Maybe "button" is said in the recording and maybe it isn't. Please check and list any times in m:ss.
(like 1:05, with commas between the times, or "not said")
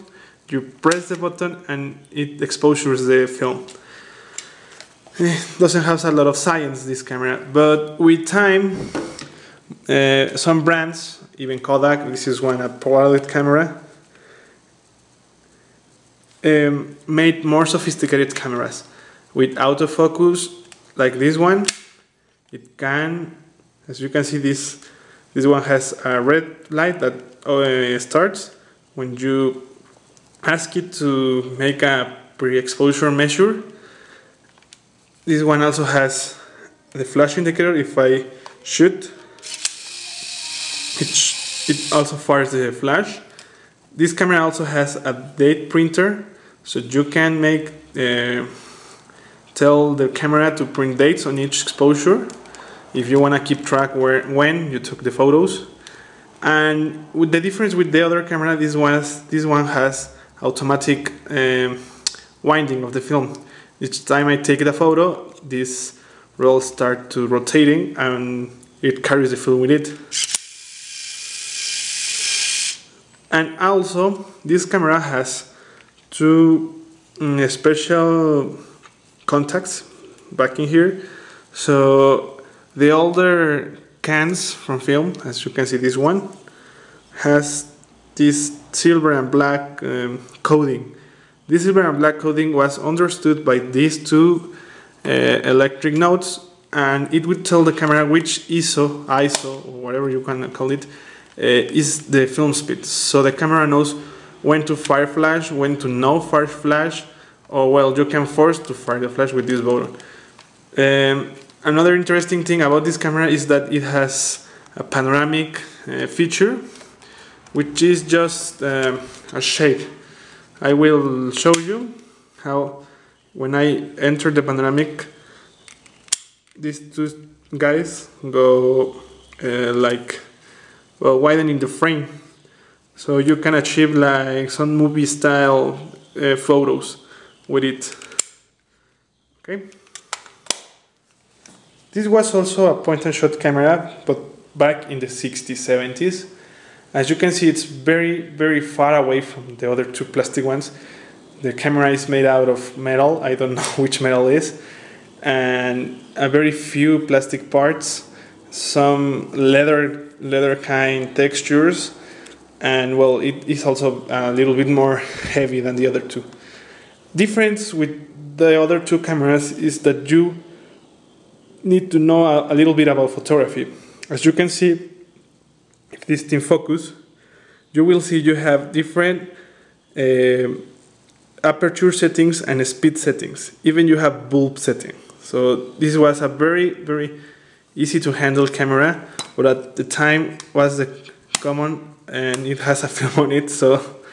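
0:01, 1:49.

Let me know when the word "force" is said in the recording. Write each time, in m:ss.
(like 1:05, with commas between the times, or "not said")
1:48.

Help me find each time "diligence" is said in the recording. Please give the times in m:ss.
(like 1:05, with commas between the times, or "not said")
not said.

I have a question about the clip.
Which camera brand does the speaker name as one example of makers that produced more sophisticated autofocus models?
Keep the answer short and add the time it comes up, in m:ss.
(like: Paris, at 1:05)
Kodak, at 0:11.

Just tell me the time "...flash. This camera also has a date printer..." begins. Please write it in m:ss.
0:42.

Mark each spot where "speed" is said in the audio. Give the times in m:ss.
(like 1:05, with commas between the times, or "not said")
1:42, 3:02.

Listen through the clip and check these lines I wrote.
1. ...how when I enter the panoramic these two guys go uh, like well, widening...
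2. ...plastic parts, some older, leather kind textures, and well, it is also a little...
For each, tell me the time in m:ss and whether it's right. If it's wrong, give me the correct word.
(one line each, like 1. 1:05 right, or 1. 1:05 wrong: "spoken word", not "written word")
1. 2:02 right
2. 2:37 wrong: "leather", not "older".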